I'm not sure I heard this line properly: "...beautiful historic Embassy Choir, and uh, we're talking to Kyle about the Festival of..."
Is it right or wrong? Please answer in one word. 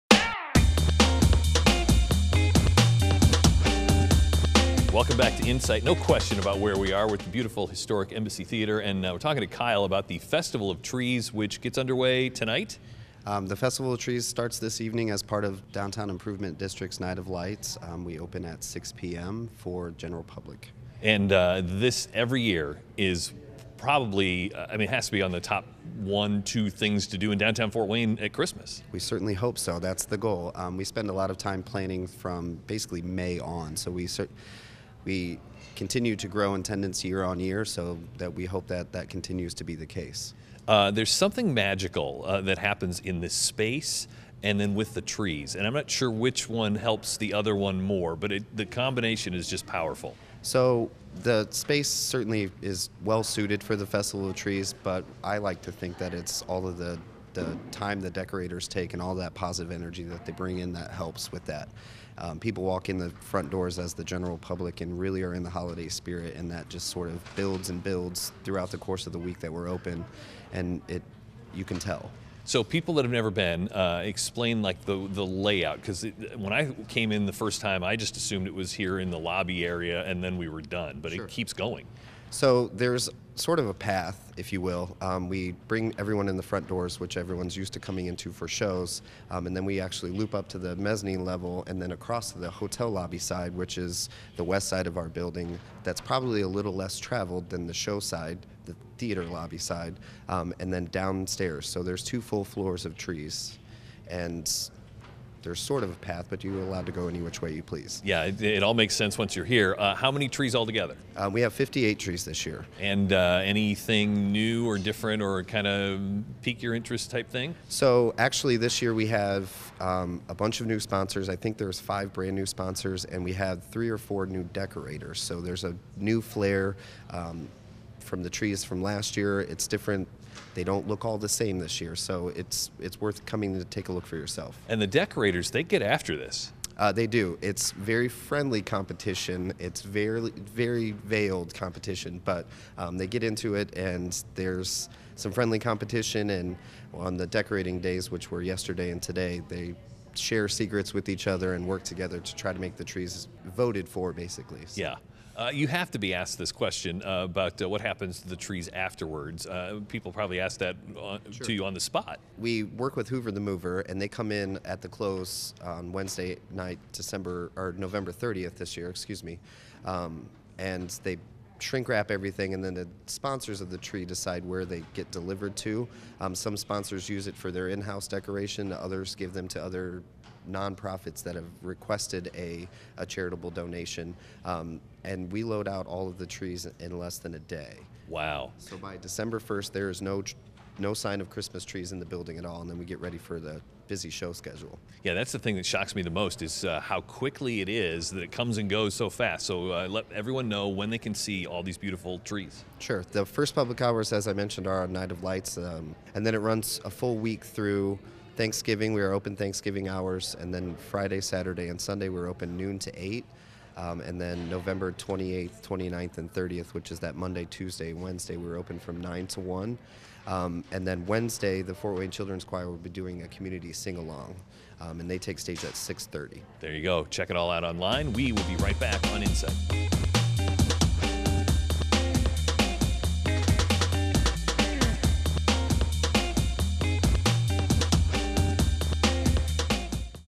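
wrong.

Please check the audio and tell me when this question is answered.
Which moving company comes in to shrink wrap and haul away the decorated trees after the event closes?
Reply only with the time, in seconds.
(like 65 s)
163 s.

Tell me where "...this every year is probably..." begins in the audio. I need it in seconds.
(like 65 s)
21 s.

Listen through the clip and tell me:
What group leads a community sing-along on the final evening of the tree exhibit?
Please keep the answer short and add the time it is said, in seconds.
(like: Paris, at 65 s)
Fort Wayne Children's Choir, at 221 s.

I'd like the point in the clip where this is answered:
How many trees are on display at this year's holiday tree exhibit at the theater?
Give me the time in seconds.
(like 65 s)
111 s.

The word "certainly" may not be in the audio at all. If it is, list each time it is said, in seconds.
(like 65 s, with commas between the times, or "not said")
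28 s, 34 s, 51 s.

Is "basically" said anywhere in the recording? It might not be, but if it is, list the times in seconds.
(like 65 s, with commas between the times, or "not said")
32 s, 154 s.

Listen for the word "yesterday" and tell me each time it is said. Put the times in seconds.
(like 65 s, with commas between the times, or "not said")
148 s.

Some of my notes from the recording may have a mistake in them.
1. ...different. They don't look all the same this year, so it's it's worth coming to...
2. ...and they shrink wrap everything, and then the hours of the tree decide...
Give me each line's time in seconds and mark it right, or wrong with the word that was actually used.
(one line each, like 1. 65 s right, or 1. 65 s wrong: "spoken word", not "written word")
1. 129 s right
2. 170 s wrong: "sponsors", not "hours".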